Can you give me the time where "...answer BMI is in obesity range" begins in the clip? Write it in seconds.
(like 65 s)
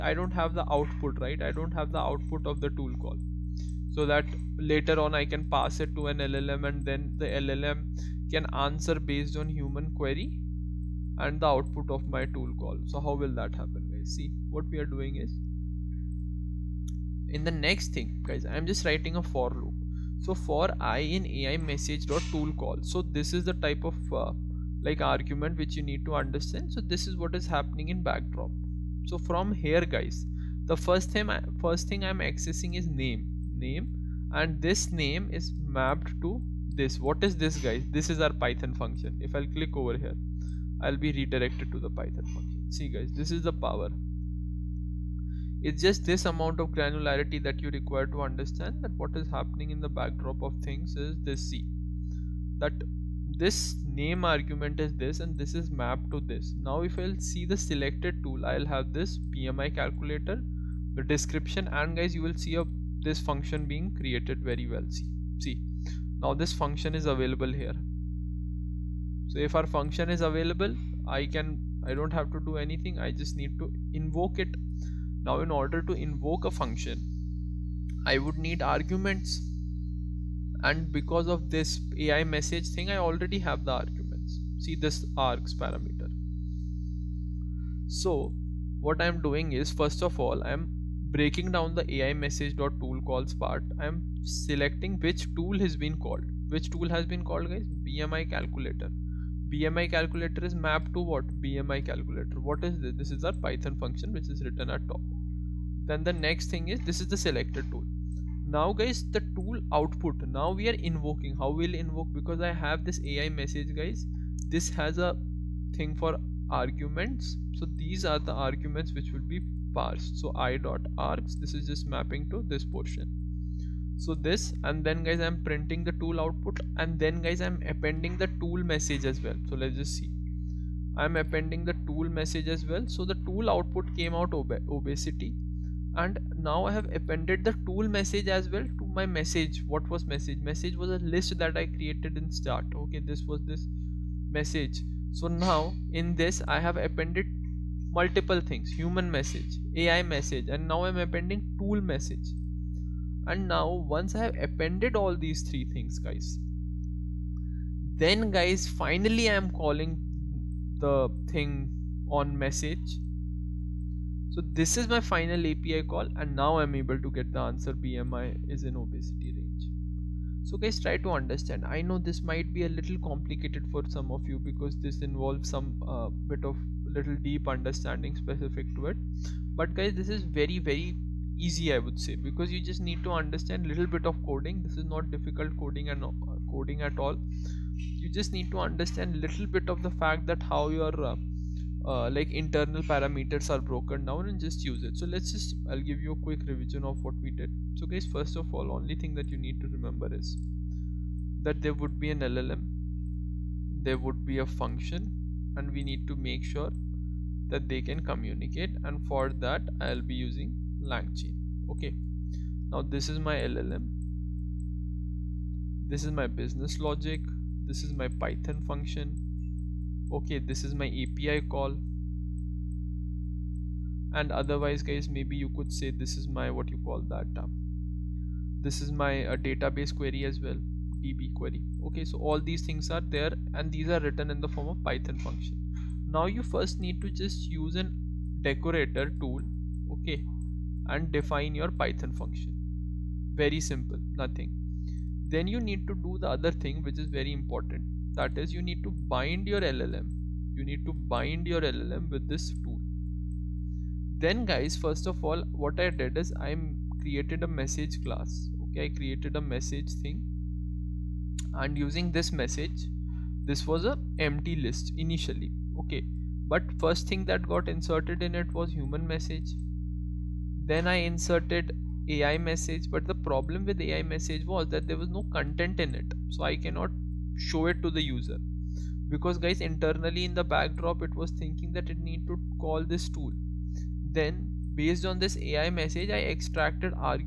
167 s.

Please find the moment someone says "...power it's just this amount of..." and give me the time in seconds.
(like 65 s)
43 s.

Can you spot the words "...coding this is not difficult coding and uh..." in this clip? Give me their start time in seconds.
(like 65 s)
184 s.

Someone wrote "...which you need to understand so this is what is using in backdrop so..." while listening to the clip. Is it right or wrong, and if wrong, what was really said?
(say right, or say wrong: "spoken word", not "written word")
wrong: "happening", not "using".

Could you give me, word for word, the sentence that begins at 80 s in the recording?
And because of this AI message thing, I already have the arguments.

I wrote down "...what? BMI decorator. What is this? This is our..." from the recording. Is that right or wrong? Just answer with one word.
wrong.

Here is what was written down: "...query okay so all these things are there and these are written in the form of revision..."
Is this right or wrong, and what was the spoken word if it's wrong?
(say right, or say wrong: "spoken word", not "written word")
wrong: "python", not "revision".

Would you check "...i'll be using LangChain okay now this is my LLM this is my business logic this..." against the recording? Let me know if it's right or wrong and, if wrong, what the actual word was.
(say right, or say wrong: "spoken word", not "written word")
right.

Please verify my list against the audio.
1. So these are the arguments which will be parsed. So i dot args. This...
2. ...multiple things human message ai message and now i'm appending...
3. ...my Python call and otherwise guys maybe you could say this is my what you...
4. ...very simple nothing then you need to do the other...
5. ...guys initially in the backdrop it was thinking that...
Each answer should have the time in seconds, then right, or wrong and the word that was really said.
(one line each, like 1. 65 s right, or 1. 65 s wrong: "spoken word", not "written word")
1. 117 s right
2. 148 s right
3. 220 s wrong: "API", not "Python"
4. 243 s right
5. 279 s wrong: "internally", not "initially".